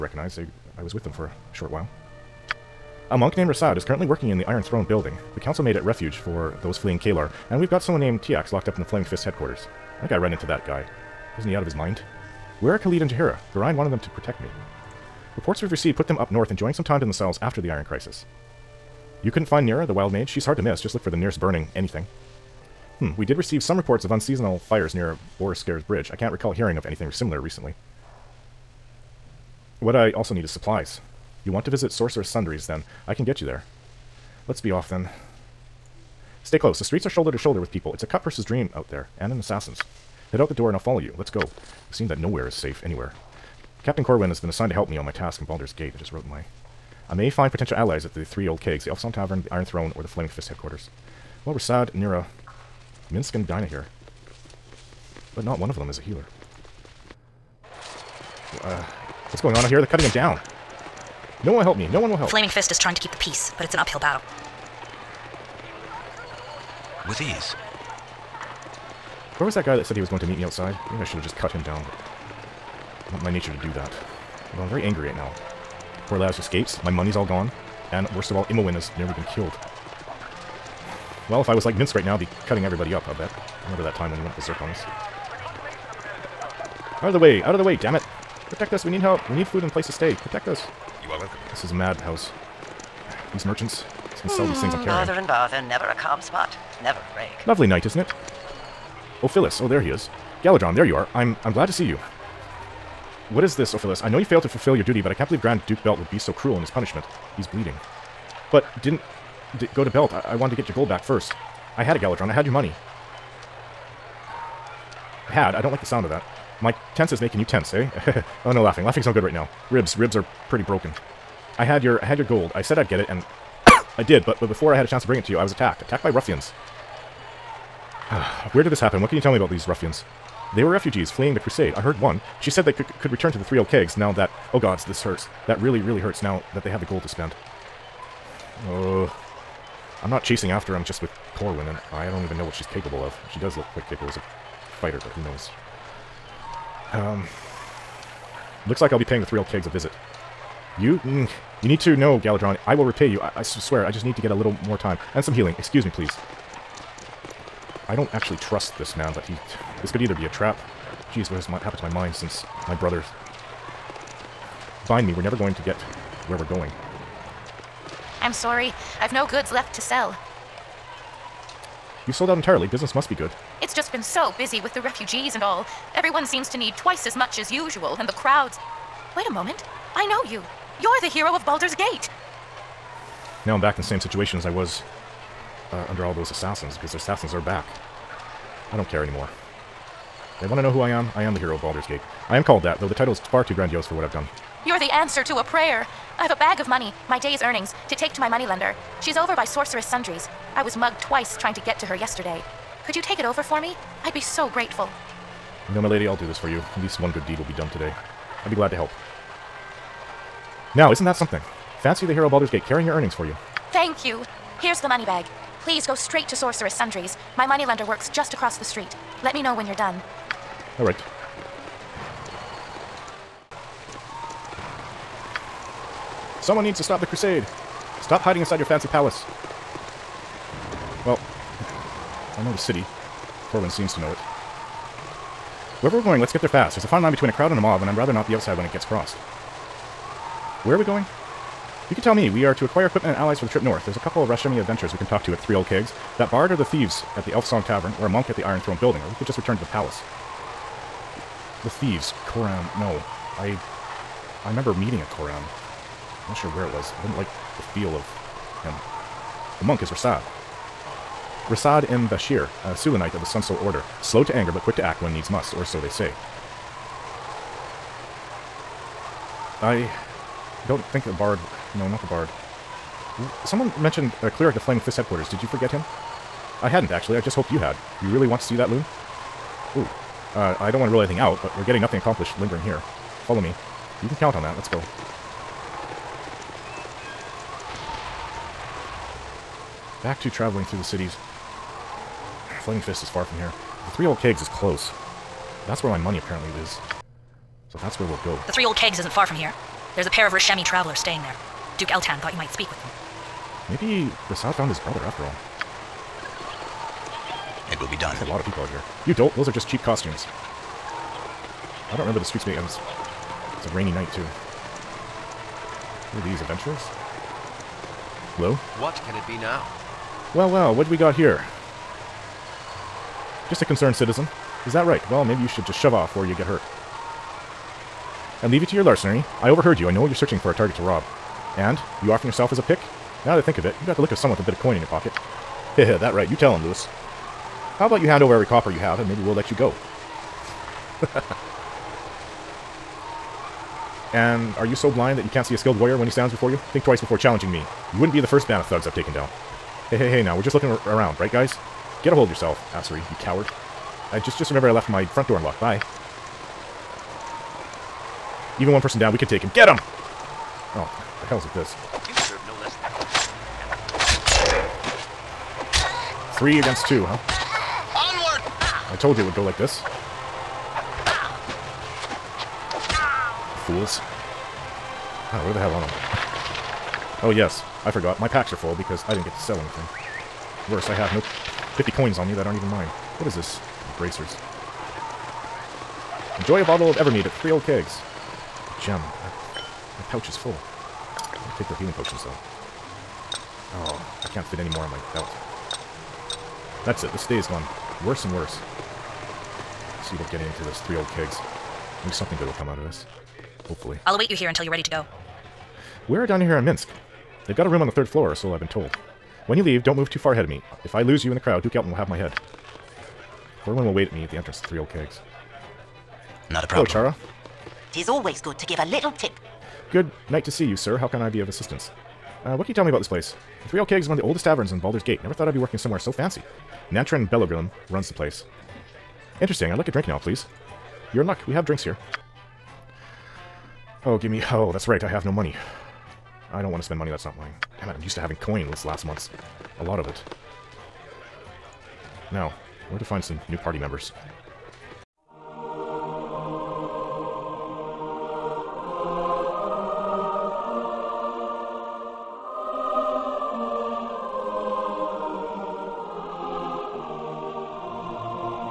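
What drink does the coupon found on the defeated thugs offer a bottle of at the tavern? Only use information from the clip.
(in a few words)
Evermead.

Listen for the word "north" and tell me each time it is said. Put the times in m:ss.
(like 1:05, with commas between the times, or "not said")
0:16, 4:03.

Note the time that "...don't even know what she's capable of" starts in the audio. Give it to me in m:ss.
2:22.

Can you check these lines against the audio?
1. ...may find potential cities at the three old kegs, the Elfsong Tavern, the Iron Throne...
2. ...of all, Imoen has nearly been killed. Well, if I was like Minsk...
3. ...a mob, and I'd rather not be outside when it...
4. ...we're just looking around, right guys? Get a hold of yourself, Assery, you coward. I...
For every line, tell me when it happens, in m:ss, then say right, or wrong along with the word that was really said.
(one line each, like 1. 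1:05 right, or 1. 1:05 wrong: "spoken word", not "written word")
1. 0:47 wrong: "allies", not "cities"
2. 1:18 right
3. 3:57 right
4. 5:50 right.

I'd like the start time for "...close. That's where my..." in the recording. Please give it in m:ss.
4:54.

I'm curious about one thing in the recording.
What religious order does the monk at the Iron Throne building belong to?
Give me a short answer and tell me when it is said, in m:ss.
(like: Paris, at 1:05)
Sun Soul Order, at 4:23.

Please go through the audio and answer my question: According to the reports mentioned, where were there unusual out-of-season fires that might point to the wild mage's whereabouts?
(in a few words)
Boareskyr's Bridge.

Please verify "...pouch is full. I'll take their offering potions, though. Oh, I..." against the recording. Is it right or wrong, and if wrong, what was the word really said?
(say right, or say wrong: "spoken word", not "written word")
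wrong: "healing", not "offering".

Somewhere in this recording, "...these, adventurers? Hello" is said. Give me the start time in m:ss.
5:16.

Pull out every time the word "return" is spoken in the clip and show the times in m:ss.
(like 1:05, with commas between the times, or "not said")
2:13, 4:09.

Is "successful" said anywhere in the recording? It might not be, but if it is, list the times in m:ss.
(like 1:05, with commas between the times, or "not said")
not said.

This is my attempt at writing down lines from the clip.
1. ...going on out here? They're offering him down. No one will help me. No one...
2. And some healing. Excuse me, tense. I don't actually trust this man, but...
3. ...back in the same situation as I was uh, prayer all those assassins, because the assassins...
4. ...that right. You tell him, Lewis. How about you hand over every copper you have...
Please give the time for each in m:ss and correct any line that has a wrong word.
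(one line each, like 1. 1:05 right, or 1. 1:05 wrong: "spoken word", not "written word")
1. 0:59 wrong: "cutting", not "offering"
2. 2:35 wrong: "please", not "tense"
3. 3:03 wrong: "under", not "prayer"
4. 5:35 right.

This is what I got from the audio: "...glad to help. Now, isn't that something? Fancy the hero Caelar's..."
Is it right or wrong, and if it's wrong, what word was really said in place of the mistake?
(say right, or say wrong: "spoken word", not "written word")
wrong: "Baldur", not "Caelar".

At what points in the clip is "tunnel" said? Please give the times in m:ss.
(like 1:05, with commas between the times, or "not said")
not said.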